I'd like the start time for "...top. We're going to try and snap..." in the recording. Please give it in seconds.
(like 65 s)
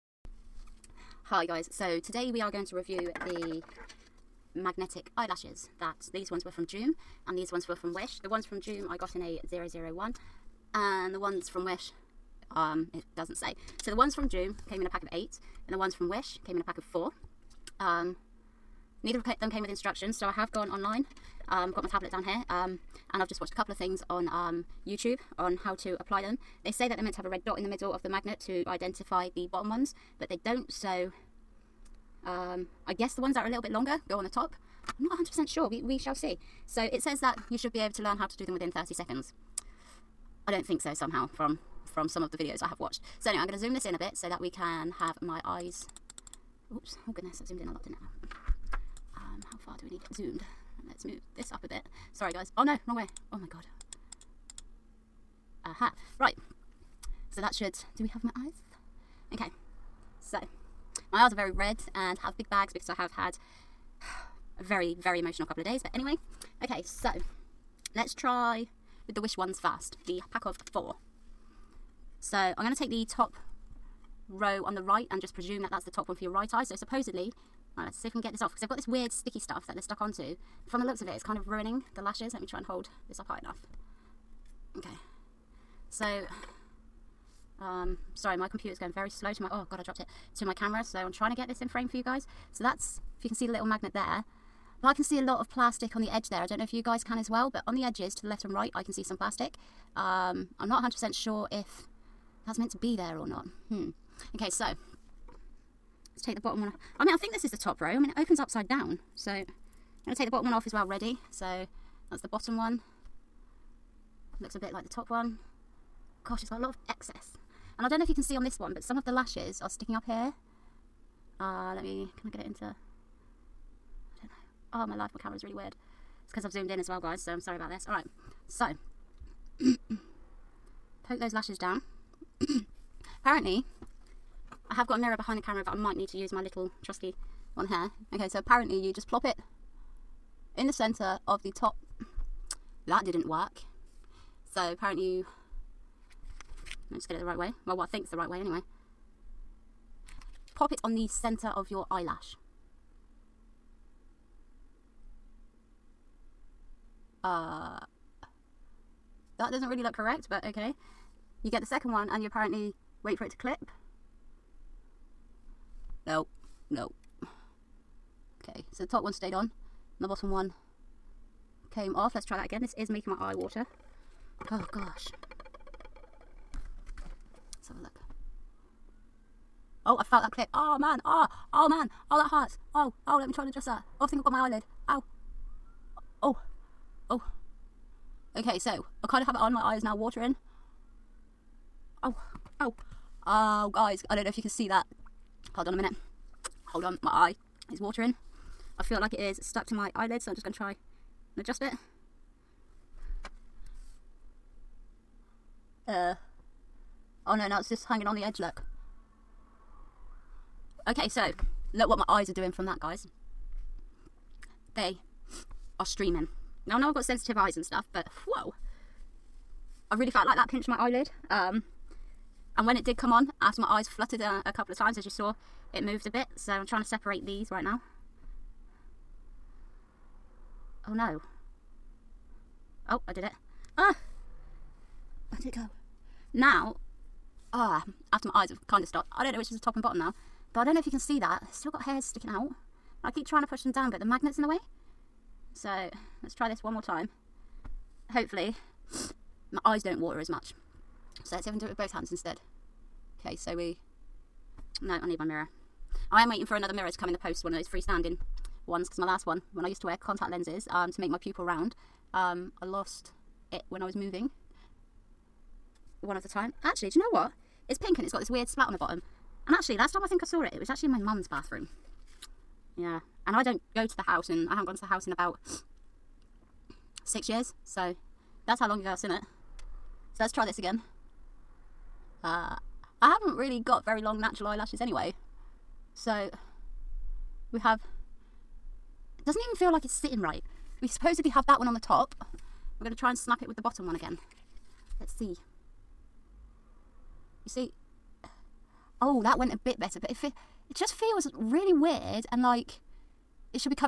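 291 s.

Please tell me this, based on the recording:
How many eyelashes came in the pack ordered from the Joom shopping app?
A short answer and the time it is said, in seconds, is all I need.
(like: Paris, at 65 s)
8, at 14 s.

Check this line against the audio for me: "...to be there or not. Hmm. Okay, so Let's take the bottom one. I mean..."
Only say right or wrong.
right.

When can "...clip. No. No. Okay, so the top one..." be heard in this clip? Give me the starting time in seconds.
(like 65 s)
163 s.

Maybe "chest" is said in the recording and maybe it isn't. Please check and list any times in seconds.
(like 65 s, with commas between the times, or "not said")
not said.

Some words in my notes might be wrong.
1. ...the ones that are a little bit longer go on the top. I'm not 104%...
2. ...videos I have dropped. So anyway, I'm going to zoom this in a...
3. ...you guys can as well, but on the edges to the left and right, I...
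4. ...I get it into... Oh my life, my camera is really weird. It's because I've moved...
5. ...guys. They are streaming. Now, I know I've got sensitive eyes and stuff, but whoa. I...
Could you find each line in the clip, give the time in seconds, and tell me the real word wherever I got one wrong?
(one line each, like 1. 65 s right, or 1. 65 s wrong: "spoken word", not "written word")
1. 33 s wrong: "100", not "104"
2. 42 s wrong: "watched", not "dropped"
3. 96 s right
4. 122 s wrong: "zoomed", not "moved"
5. 212 s right.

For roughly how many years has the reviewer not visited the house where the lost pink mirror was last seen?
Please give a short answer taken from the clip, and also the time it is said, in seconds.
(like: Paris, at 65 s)
6, at 277 s.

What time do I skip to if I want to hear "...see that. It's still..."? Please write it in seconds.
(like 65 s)
240 s.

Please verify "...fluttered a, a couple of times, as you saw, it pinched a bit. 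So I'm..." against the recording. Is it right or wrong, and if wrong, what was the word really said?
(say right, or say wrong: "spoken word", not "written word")
wrong: "moved", not "pinched".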